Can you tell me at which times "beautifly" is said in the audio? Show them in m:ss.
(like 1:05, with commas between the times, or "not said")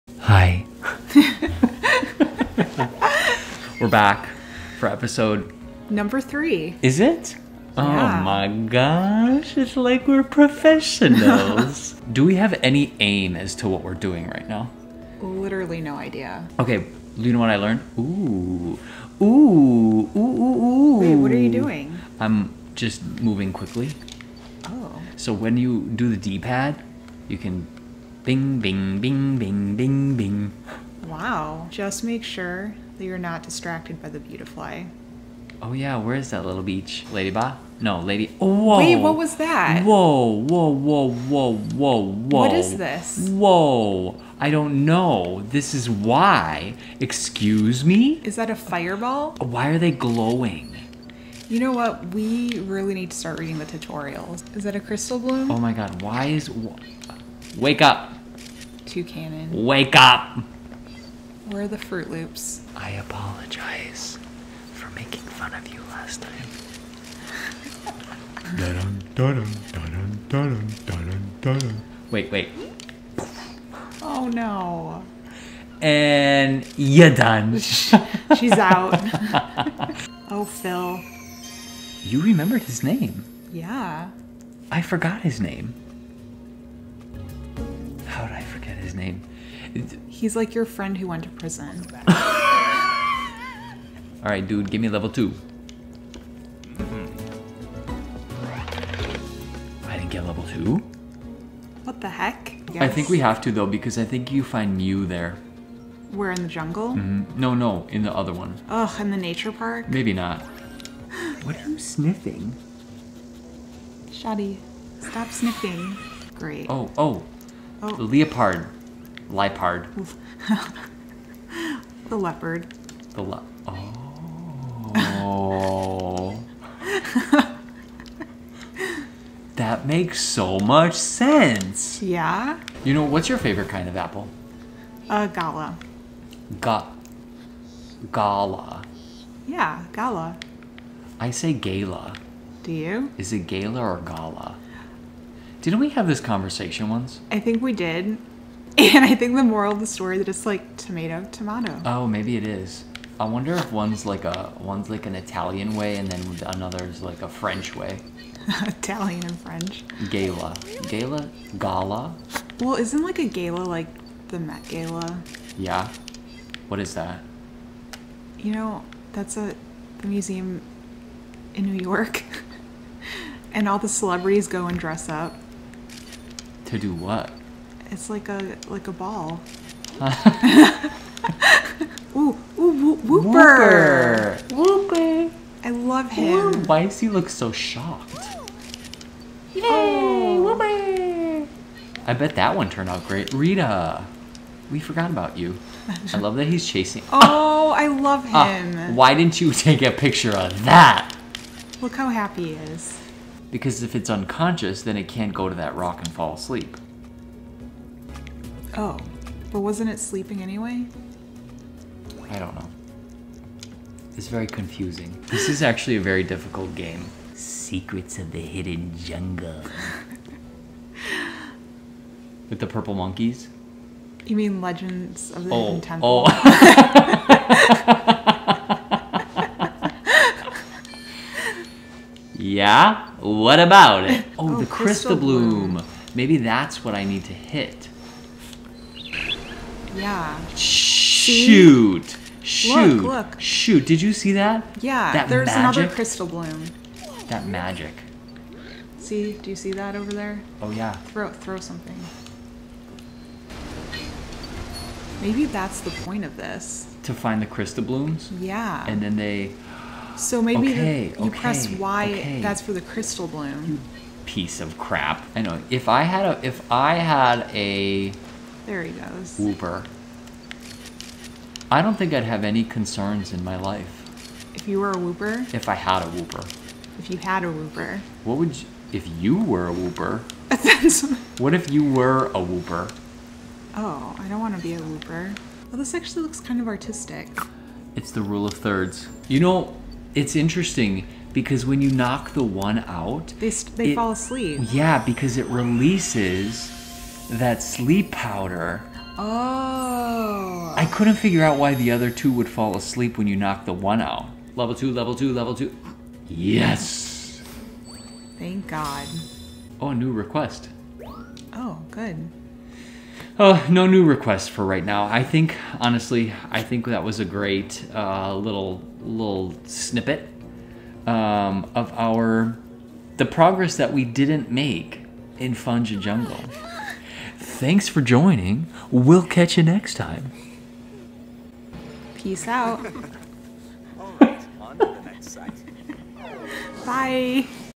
0:34.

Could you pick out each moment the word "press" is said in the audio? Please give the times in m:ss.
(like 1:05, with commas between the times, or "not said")
4:21.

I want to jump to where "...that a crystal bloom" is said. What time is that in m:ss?
0:54.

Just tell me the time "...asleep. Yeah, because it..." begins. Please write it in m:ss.
4:54.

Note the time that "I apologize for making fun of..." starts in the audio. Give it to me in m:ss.
1:02.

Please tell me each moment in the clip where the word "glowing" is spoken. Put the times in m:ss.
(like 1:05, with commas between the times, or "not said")
0:49.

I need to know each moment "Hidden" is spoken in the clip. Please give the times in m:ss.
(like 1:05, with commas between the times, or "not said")
3:38, 3:45.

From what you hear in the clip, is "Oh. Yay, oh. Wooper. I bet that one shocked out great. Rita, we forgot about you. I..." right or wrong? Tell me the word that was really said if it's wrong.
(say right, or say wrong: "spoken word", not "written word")
wrong: "turned", not "shocked".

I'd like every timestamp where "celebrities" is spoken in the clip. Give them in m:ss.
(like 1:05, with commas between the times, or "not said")
2:53.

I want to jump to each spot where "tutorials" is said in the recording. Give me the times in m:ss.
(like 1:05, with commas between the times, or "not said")
0:53.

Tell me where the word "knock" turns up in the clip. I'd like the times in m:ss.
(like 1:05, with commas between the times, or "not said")
4:51, 5:03.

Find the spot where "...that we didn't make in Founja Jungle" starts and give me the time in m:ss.
5:23.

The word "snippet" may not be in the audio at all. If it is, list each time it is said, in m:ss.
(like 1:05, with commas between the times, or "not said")
5:19.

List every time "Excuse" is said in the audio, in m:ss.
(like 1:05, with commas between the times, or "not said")
0:46.